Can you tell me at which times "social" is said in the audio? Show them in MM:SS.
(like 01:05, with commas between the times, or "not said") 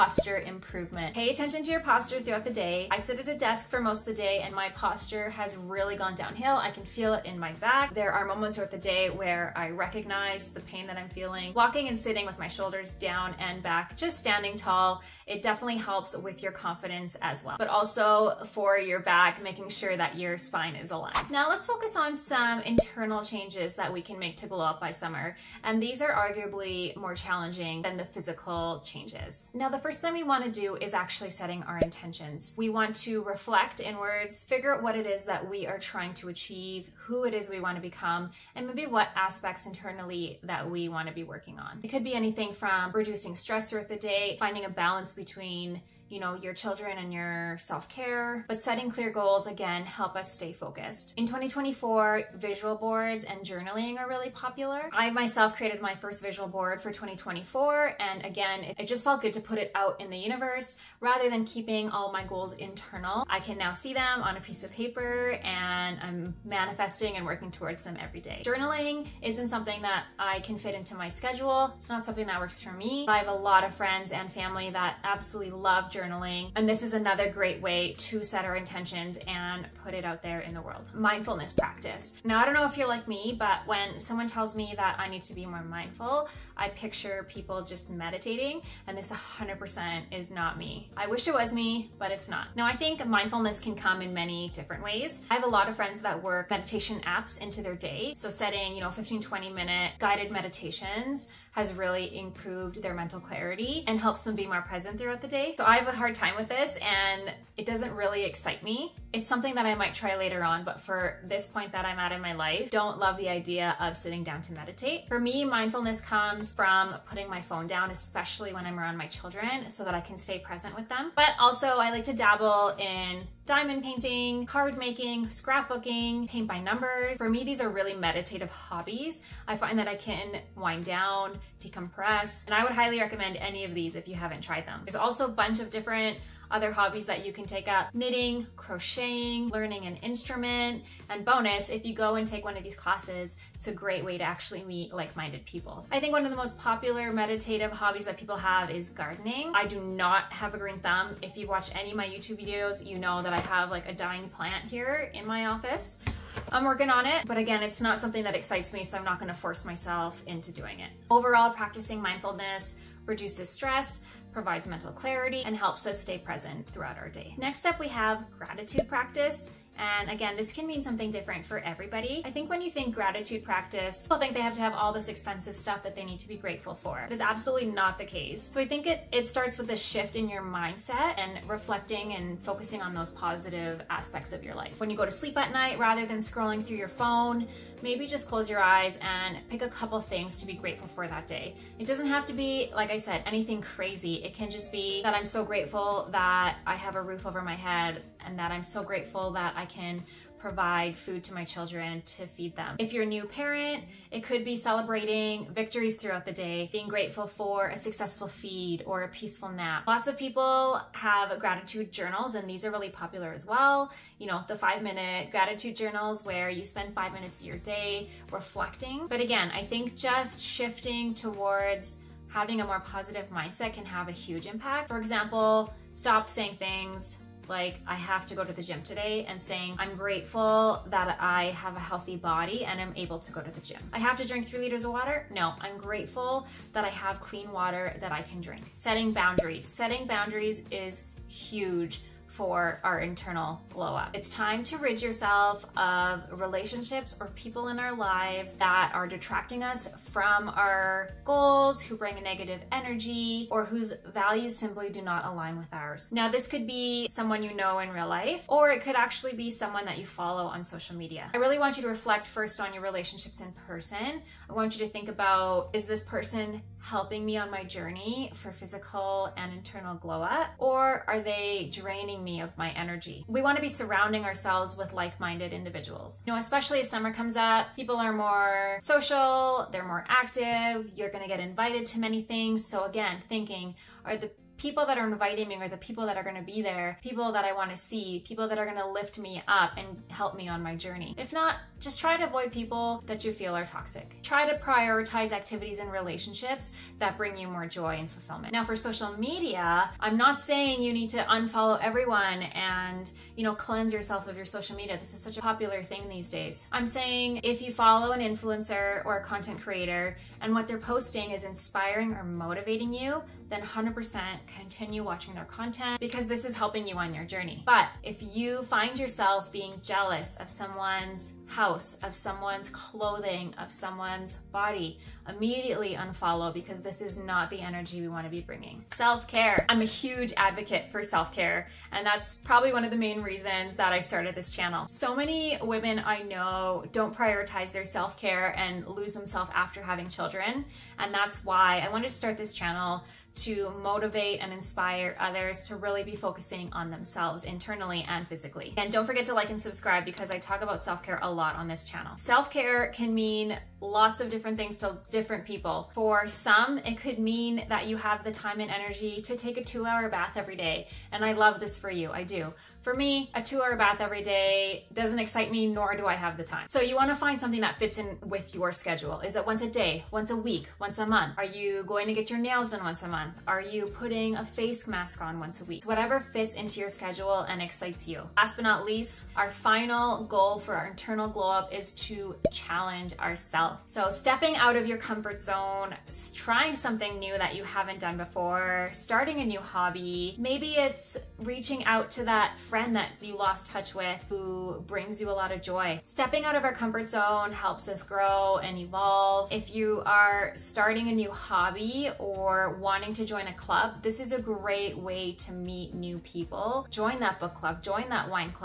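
04:20, 04:38, 04:58, 05:04.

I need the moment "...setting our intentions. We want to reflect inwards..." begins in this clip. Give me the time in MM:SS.
00:31.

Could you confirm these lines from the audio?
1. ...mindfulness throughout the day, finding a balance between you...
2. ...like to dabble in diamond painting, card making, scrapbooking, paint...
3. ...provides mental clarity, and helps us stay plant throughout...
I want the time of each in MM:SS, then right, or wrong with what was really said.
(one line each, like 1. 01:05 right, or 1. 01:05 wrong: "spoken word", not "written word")
1. 00:43 wrong: "stress", not "mindfulness"
2. 02:01 right
3. 02:44 wrong: "present", not "plant".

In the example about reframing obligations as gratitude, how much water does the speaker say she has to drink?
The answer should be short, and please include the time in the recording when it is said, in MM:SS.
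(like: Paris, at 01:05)
3 liters, at 03:54.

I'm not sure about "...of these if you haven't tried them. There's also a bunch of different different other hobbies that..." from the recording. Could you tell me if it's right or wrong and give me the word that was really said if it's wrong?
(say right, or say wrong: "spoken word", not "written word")
right.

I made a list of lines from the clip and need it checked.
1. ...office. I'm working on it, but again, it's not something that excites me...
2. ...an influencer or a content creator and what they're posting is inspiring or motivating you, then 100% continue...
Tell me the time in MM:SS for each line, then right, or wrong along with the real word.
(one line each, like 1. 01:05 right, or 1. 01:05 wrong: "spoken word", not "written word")
1. 02:35 right
2. 05:08 right.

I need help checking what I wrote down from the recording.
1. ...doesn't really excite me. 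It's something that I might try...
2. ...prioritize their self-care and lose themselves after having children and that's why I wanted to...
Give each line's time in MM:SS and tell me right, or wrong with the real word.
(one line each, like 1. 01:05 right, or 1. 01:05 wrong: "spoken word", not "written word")
1. 01:47 right
2. 05:37 right.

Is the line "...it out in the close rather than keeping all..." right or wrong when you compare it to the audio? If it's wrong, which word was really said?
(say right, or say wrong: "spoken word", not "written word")
wrong: "universe", not "close".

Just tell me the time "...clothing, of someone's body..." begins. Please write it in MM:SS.
05:22.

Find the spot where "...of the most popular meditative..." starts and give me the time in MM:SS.
02:26.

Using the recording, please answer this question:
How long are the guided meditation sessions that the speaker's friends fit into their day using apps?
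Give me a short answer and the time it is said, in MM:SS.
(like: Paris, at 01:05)
15-20 minutes, at 01:38.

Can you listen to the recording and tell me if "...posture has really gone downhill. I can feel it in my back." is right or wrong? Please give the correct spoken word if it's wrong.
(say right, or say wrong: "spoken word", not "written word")
right.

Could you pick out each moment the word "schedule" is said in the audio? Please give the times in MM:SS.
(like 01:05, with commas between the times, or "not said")
01:11, 06:08, 06:16.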